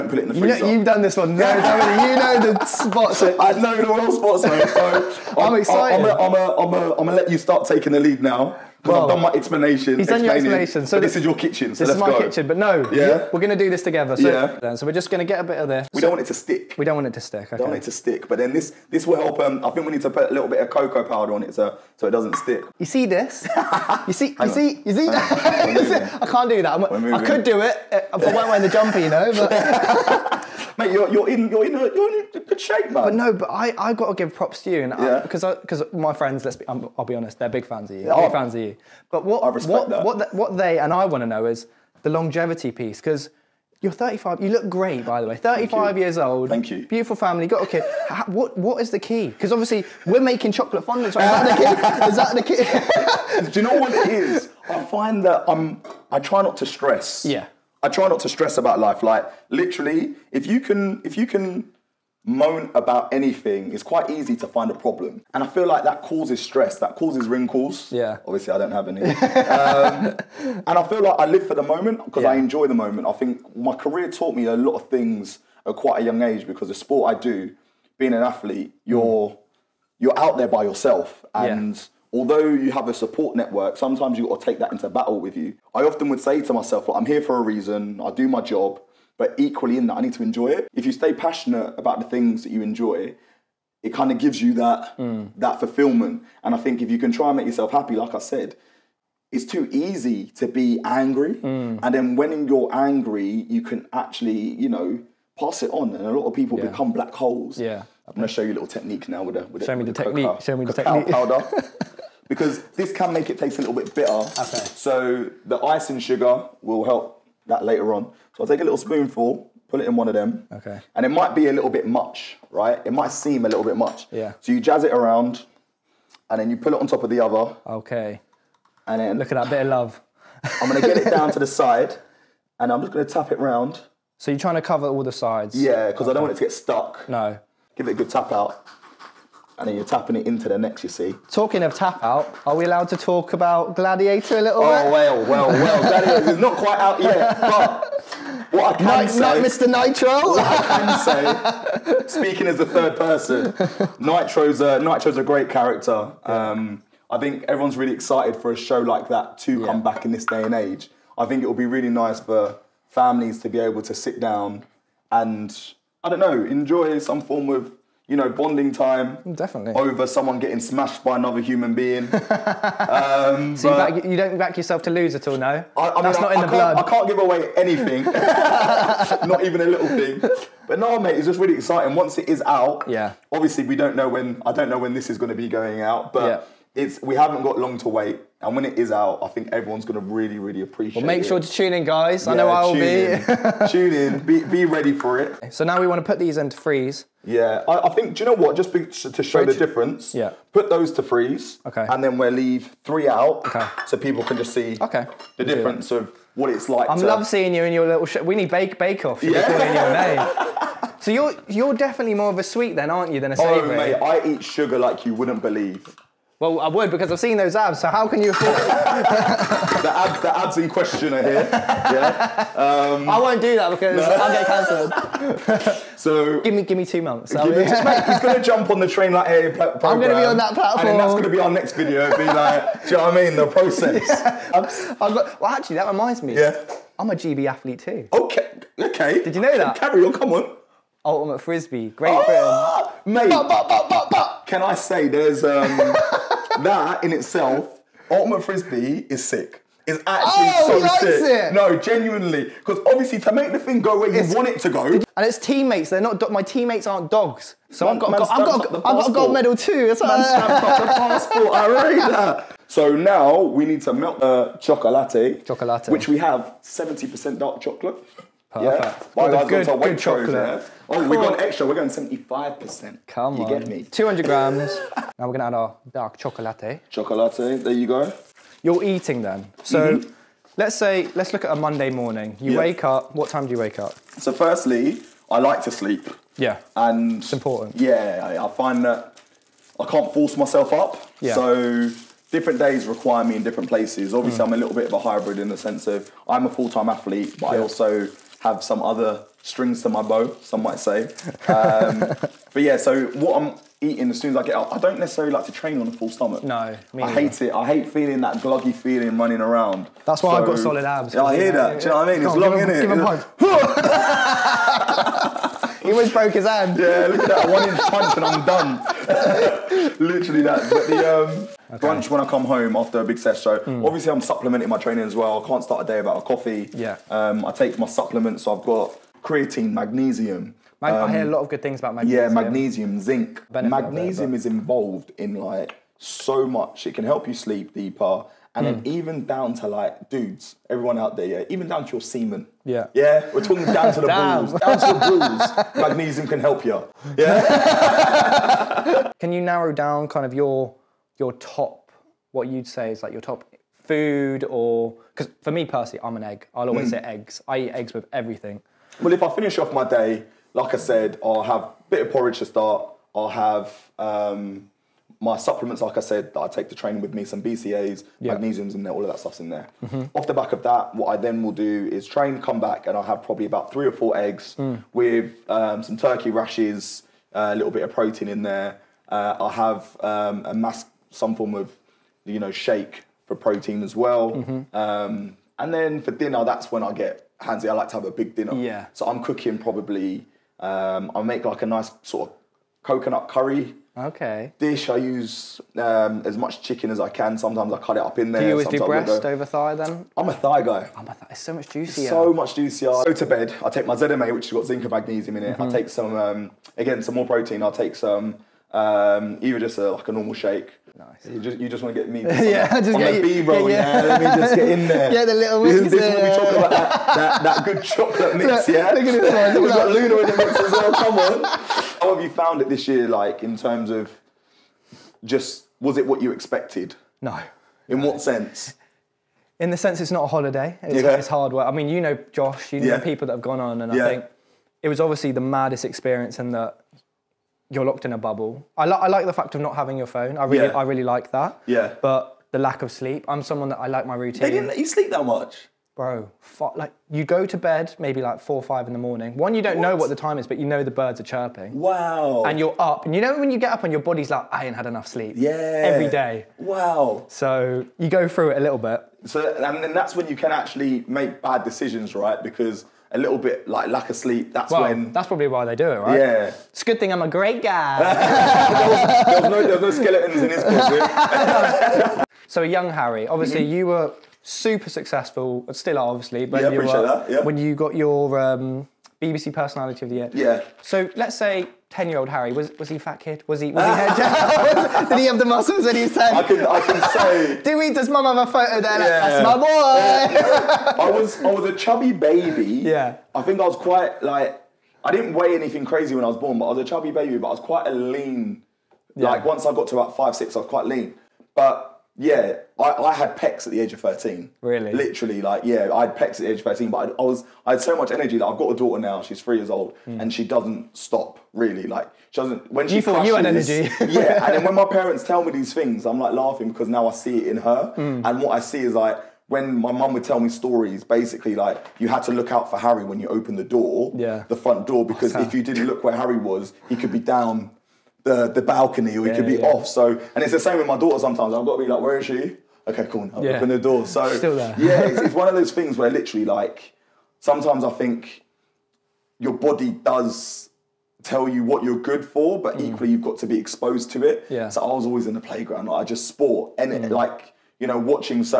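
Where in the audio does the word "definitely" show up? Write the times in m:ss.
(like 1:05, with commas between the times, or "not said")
2:49, 3:31.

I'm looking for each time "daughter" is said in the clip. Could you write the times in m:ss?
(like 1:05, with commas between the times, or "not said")
8:28, 8:50.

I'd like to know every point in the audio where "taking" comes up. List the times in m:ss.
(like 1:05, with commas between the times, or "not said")
0:07.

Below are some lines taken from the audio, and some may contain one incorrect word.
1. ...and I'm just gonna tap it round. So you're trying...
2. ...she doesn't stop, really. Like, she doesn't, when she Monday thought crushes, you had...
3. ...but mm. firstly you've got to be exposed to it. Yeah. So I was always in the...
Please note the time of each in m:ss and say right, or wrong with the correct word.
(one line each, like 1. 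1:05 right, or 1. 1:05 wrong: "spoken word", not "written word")
1. 2:12 right
2. 8:30 wrong: "You", not "Monday"
3. 9:02 wrong: "equally", not "firstly".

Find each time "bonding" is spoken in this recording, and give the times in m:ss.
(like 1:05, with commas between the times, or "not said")
2:48.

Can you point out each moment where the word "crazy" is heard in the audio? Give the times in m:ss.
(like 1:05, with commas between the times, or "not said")
8:15.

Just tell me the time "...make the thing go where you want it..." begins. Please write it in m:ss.
4:13.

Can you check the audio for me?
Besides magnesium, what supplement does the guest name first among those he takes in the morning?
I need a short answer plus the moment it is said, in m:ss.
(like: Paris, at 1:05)
creatine, at 5:29.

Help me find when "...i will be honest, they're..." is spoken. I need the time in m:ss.
0:36.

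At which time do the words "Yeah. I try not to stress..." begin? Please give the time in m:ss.
0:57.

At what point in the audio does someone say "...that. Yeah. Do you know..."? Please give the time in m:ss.
5:11.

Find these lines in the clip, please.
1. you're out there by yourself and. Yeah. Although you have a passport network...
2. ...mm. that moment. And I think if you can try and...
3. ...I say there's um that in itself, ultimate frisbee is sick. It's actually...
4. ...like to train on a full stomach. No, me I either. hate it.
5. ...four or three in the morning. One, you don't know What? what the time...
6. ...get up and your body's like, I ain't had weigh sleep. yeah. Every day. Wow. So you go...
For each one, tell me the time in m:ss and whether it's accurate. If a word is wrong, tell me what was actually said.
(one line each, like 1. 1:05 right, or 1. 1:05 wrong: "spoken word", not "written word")
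1. 1:19 wrong: "support", not "passport"
2. 1:34 wrong: "fulfillment", not "moment"
3. 4:04 right
4. 5:05 right
5. 7:28 wrong: "five", not "three"
6. 7:33 wrong: "enough", not "weigh".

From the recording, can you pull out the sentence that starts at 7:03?
Like in terms of just was it what you expected?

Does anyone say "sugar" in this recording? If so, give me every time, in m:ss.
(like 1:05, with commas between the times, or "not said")
1:55, 3:34.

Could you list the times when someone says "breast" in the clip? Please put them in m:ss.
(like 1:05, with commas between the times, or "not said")
6:38.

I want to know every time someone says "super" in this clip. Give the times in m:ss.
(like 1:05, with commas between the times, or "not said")
7:54.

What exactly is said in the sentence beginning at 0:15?
We so, don't want it to stick.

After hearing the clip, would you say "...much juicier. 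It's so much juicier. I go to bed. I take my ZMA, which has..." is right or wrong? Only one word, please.
right.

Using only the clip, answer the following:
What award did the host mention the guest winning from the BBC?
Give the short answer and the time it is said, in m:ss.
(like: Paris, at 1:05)
BBC Personality of the Year, at 7:59.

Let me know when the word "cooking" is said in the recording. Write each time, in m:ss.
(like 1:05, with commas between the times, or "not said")
6:29.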